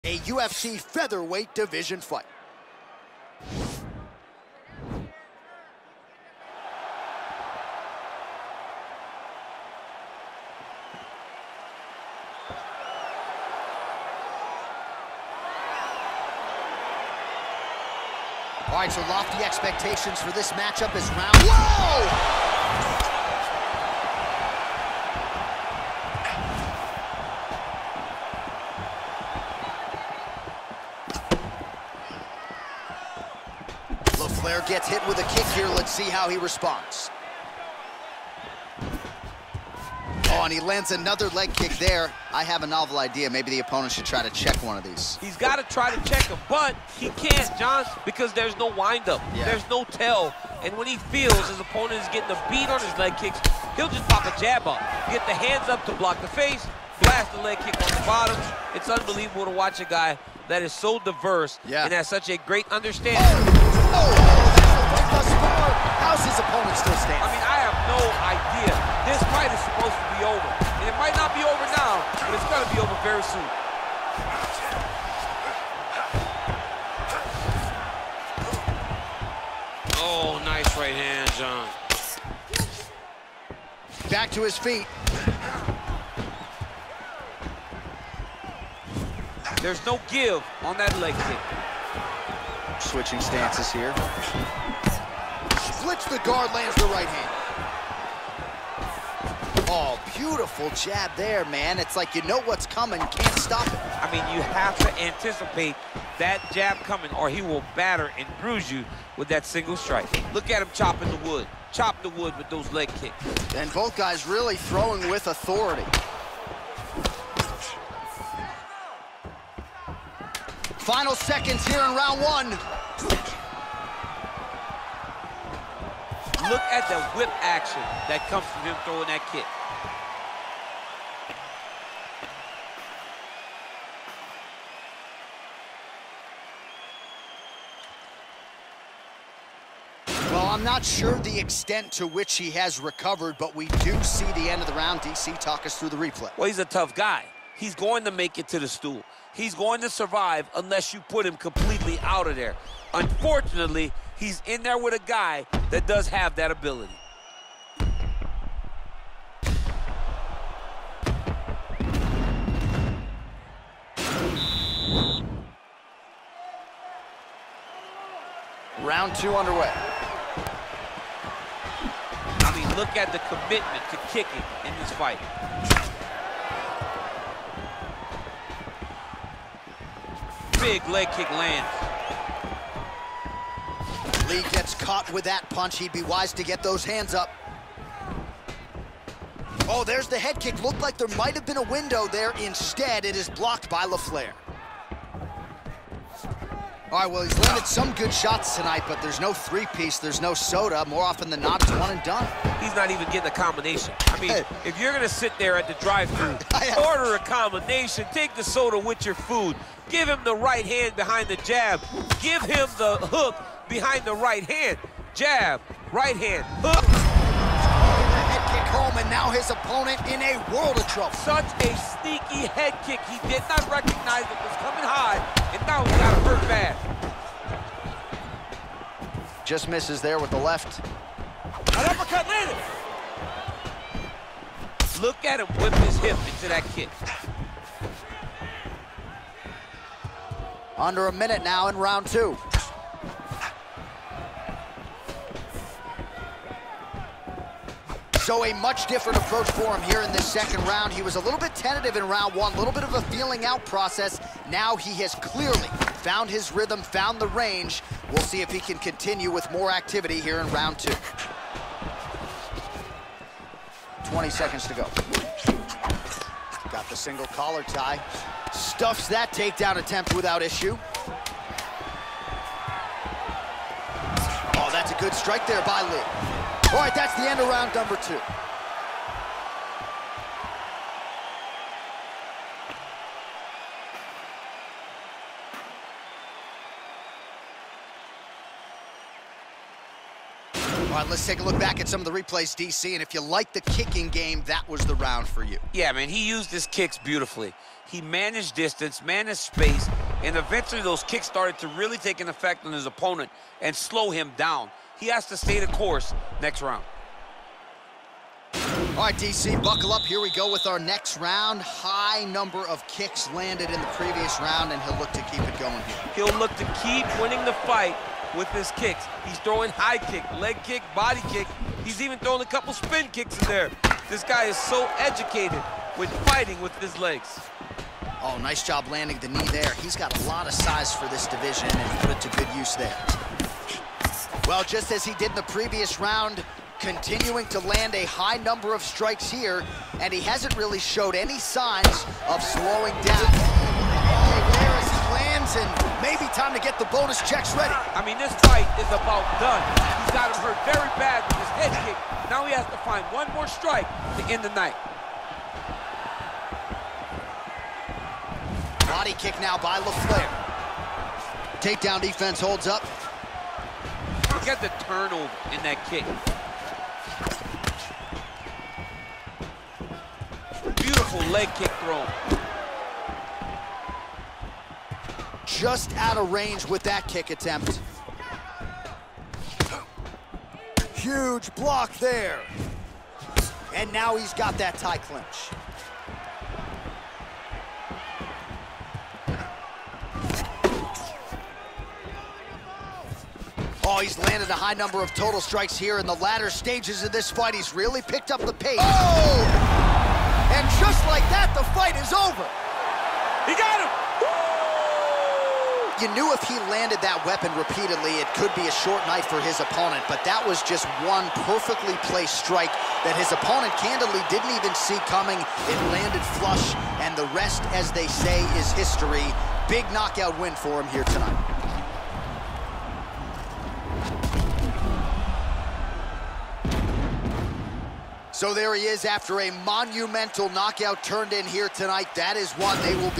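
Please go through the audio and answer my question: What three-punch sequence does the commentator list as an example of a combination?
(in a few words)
Jab, right hand, hook.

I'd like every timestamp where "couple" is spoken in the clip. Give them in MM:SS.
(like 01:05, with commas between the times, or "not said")
05:22.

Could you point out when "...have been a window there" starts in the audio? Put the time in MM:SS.
03:11.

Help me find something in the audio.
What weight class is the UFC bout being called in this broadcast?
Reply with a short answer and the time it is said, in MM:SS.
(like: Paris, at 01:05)
Featherweight, at 00:00.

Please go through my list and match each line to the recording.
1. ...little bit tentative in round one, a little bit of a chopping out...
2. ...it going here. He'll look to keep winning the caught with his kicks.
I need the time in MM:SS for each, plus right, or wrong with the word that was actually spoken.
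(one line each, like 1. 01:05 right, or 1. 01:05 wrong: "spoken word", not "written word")
1. 04:11 wrong: "feeling", not "chopping"
2. 05:15 wrong: "fight", not "caught".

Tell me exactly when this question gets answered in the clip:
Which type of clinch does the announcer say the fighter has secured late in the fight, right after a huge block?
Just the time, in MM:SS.
06:24.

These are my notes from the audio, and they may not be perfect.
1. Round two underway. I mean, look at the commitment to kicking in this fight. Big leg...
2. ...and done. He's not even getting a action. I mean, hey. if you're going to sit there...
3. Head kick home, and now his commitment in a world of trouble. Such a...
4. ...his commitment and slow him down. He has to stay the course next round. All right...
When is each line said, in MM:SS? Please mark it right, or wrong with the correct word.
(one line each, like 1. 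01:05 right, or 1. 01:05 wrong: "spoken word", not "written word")
1. 02:48 right
2. 03:21 wrong: "combination", not "action"
3. 03:38 wrong: "opponent", not "commitment"
4. 05:02 wrong: "opponent", not "commitment".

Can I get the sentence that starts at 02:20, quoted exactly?
Well, I'm not sure the extent to which he has recovered, but we do see the end of the round.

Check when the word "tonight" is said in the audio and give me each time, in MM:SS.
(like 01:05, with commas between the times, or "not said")
03:18, 07:01, 07:11.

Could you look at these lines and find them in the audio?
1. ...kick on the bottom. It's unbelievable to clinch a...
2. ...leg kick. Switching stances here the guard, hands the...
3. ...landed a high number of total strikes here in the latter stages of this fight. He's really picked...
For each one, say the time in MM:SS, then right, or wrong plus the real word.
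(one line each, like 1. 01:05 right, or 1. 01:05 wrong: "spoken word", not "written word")
1. 00:57 wrong: "watch", not "clinch"
2. 01:30 wrong: "lands", not "hands"
3. 06:34 right.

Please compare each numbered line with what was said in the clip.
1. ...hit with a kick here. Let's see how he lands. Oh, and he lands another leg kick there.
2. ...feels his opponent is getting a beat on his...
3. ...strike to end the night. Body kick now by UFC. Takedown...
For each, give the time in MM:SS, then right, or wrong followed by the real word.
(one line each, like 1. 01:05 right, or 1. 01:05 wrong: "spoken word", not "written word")
1. 00:34 wrong: "responds", not "lands"
2. 00:50 right
3. 05:53 wrong: "LaFlare", not "UFC".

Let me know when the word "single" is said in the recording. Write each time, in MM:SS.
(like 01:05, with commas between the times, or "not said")
01:49, 04:26.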